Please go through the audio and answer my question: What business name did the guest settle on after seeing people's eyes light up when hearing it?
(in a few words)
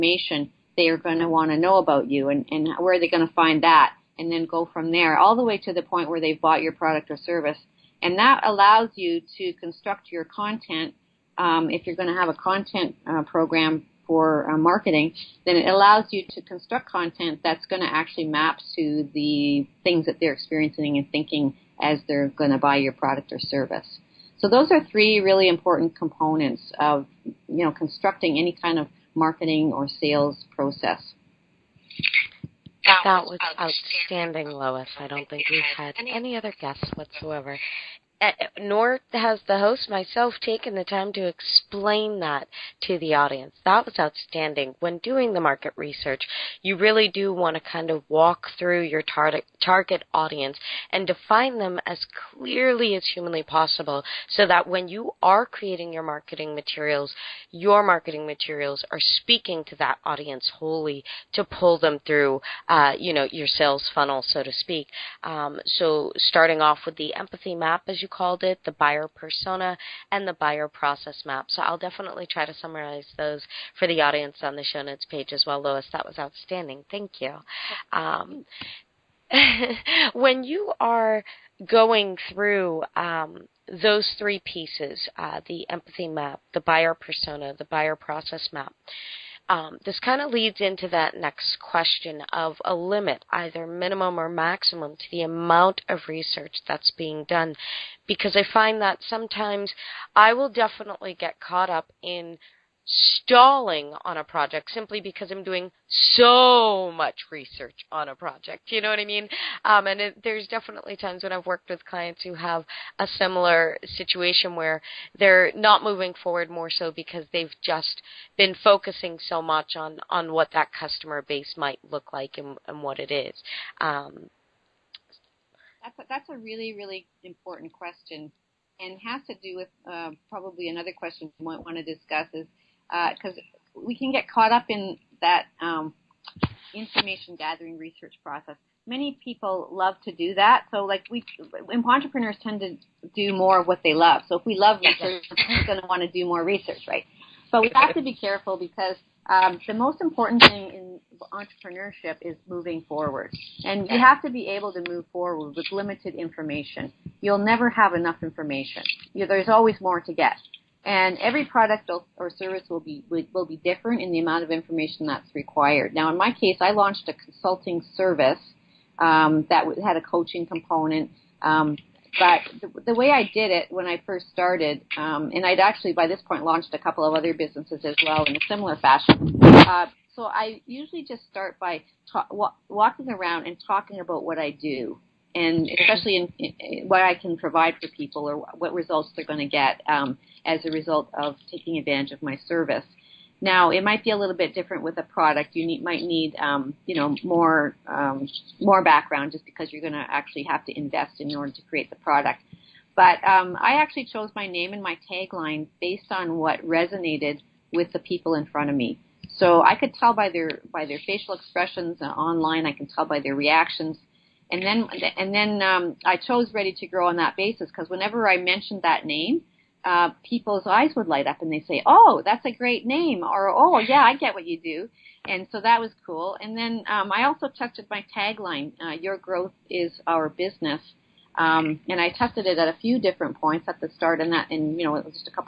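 Ready to Grow.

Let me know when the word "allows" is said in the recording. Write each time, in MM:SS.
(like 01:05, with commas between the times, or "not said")
00:08, 00:15.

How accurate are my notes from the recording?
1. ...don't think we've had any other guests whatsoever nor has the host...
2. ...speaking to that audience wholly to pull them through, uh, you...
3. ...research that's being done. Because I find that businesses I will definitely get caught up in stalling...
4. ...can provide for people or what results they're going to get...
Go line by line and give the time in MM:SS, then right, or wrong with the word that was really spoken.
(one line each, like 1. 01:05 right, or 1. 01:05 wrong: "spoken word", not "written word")
1. 00:35 right
2. 00:59 right
3. 01:36 wrong: "sometimes", not "businesses"
4. 03:07 right.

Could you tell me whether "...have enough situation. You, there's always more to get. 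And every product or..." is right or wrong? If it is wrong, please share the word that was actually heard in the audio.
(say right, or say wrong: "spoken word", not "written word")
wrong: "information", not "situation".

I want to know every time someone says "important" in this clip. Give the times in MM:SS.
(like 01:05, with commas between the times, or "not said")
00:25, 02:07, 02:30.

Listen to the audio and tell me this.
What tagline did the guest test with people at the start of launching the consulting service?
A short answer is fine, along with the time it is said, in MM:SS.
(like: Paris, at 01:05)
Your growth is our business, at 03:48.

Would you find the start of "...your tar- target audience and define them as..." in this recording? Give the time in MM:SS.
00:48.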